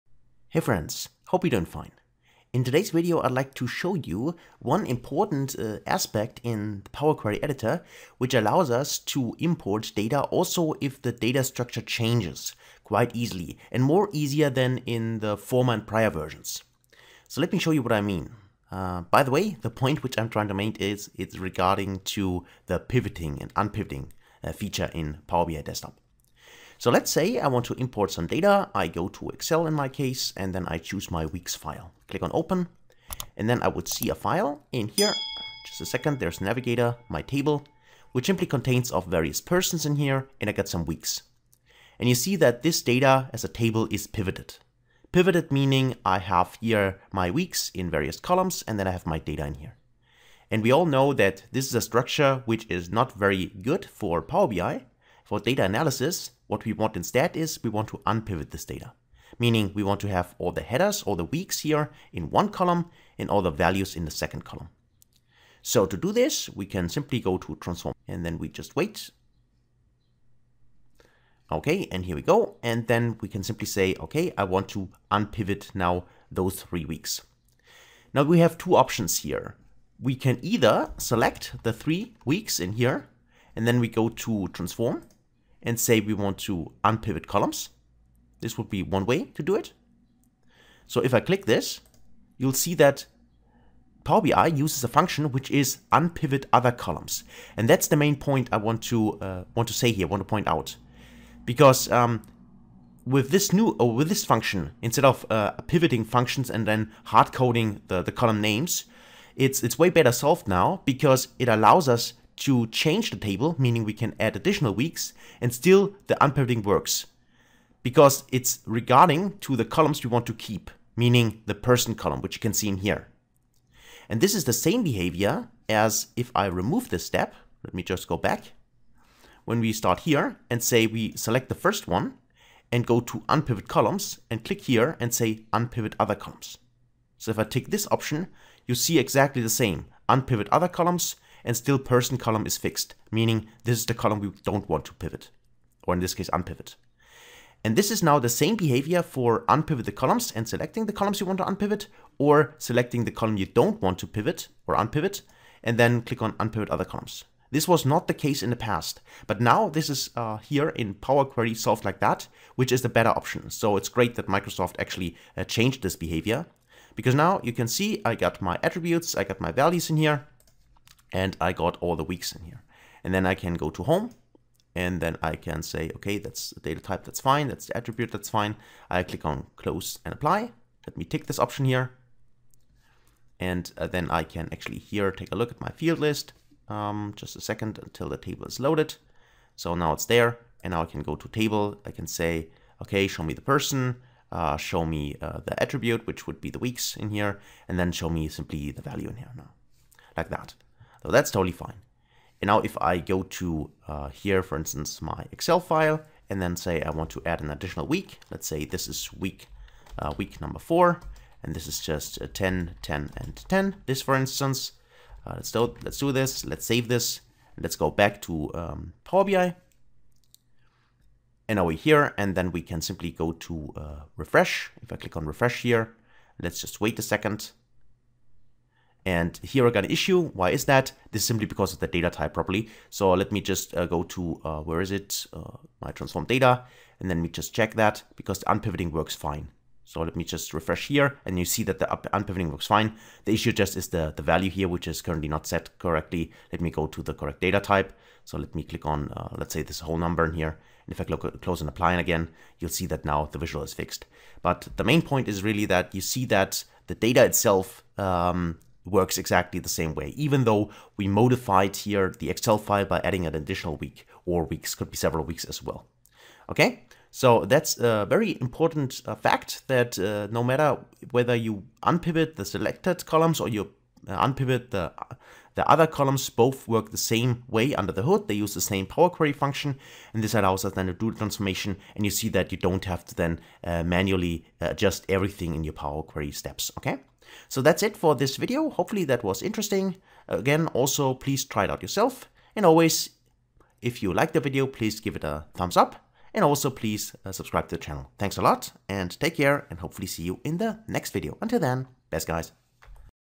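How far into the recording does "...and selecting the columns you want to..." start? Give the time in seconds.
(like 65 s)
150 s.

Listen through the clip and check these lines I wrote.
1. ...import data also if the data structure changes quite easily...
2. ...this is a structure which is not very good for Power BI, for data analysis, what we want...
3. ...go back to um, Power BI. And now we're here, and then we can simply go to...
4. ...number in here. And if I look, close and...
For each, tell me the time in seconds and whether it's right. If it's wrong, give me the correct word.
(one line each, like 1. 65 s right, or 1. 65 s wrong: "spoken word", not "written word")
1. 9 s right
2. 51 s right
3. 217 s right
4. 249 s right.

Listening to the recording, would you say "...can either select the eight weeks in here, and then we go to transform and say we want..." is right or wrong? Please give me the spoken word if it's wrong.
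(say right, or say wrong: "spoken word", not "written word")
wrong: "three", not "eight".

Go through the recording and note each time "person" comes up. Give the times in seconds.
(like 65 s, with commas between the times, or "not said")
39 s, 121 s, 141 s, 193 s.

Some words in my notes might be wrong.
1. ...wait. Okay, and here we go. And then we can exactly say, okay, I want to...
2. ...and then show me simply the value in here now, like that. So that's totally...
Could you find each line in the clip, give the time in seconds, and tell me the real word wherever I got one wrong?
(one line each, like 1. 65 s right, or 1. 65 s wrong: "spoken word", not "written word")
1. 68 s wrong: "simply", not "exactly"
2. 197 s right.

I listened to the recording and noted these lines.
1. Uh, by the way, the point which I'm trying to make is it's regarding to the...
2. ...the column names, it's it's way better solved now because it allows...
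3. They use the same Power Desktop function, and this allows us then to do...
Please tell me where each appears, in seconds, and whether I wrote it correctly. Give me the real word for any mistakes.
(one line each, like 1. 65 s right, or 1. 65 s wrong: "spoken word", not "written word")
1. 18 s right
2. 108 s right
3. 278 s wrong: "Query", not "Desktop".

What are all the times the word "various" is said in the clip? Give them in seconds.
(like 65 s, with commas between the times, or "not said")
39 s, 47 s.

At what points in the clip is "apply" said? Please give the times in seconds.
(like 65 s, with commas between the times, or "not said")
180 s, 251 s.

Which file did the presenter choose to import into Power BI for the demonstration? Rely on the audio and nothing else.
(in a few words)
weeks file.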